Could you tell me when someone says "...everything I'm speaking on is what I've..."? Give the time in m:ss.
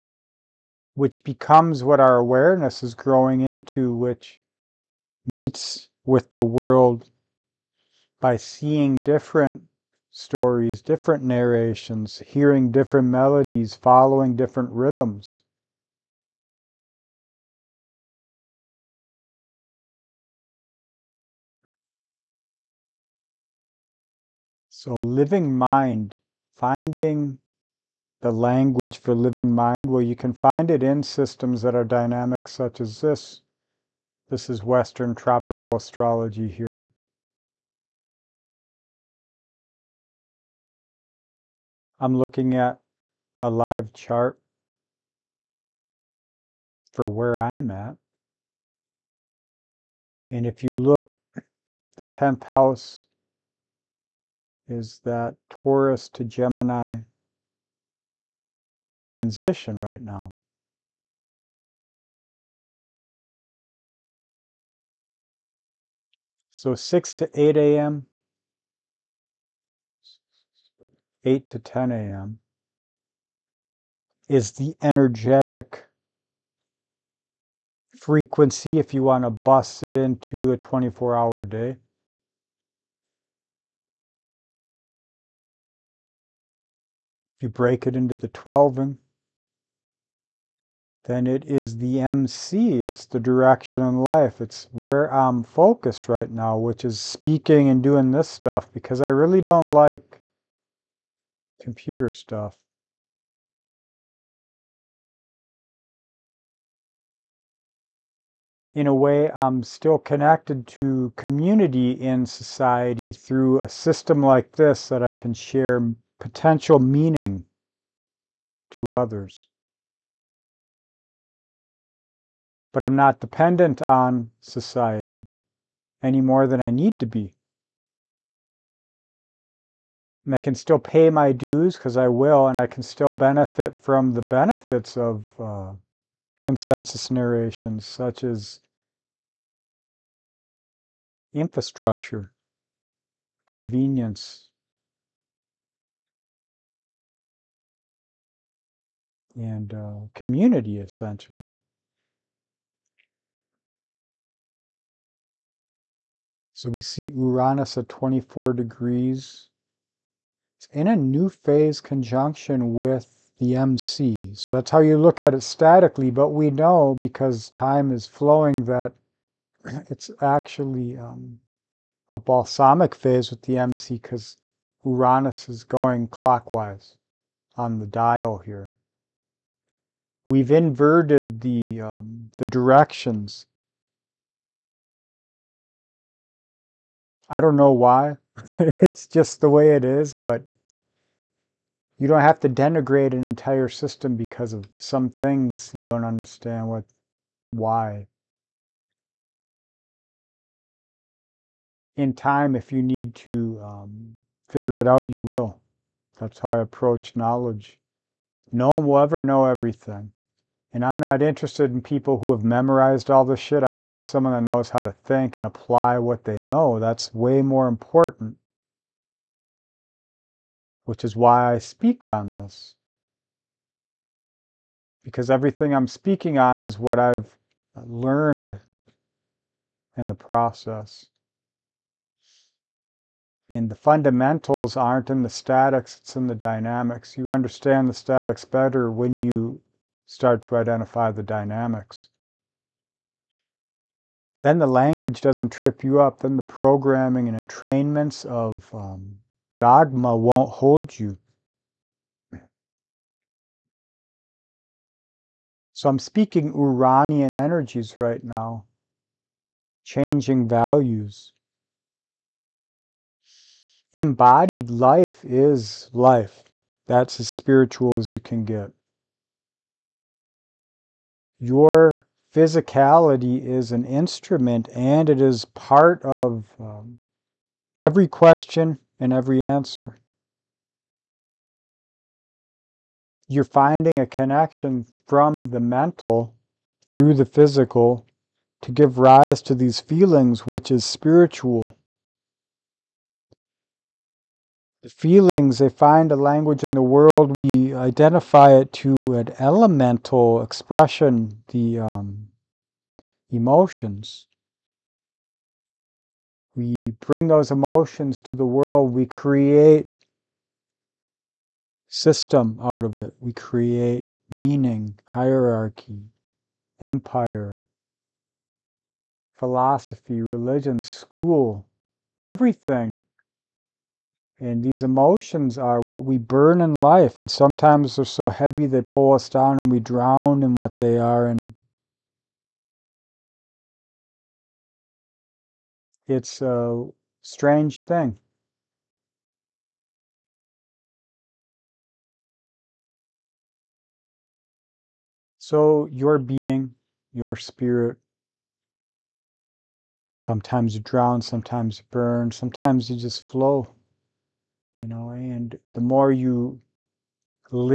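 3:45.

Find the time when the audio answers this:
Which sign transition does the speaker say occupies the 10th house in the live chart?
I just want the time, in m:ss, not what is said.
0:55.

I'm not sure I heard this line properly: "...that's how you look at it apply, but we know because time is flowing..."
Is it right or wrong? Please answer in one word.
wrong.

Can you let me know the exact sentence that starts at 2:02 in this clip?
But I'm not dependent on society any more than I need to be.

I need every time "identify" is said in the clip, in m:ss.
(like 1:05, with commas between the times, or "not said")
4:00, 4:57.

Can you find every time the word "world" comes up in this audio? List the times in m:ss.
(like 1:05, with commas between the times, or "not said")
0:06, 4:56, 5:08.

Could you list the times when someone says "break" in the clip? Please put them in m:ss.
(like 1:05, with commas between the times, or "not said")
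1:27.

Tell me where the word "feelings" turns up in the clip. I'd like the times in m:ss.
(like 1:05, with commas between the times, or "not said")
4:49, 4:54.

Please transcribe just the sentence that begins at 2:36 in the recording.
So we see Uranus at 24 degrees.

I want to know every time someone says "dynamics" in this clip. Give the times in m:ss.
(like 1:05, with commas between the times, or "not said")
0:31, 3:56, 4:01.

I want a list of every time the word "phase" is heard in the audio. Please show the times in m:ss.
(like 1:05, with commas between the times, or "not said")
2:41, 2:52.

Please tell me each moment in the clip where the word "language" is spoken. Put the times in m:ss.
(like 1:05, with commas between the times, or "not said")
0:28, 4:04, 4:56.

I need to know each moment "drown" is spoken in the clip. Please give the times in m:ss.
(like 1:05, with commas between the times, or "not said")
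5:29, 5:50.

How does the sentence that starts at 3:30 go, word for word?
And I'm not interested in people who have memorized all this shit.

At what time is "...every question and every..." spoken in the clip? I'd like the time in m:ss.
4:37.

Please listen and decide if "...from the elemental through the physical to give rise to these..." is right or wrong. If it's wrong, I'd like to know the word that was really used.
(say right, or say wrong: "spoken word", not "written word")
wrong: "mental", not "elemental".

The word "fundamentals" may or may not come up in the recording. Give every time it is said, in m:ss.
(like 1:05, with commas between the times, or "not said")
3:53.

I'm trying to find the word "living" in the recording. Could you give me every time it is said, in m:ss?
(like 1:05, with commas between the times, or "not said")
0:24, 0:29.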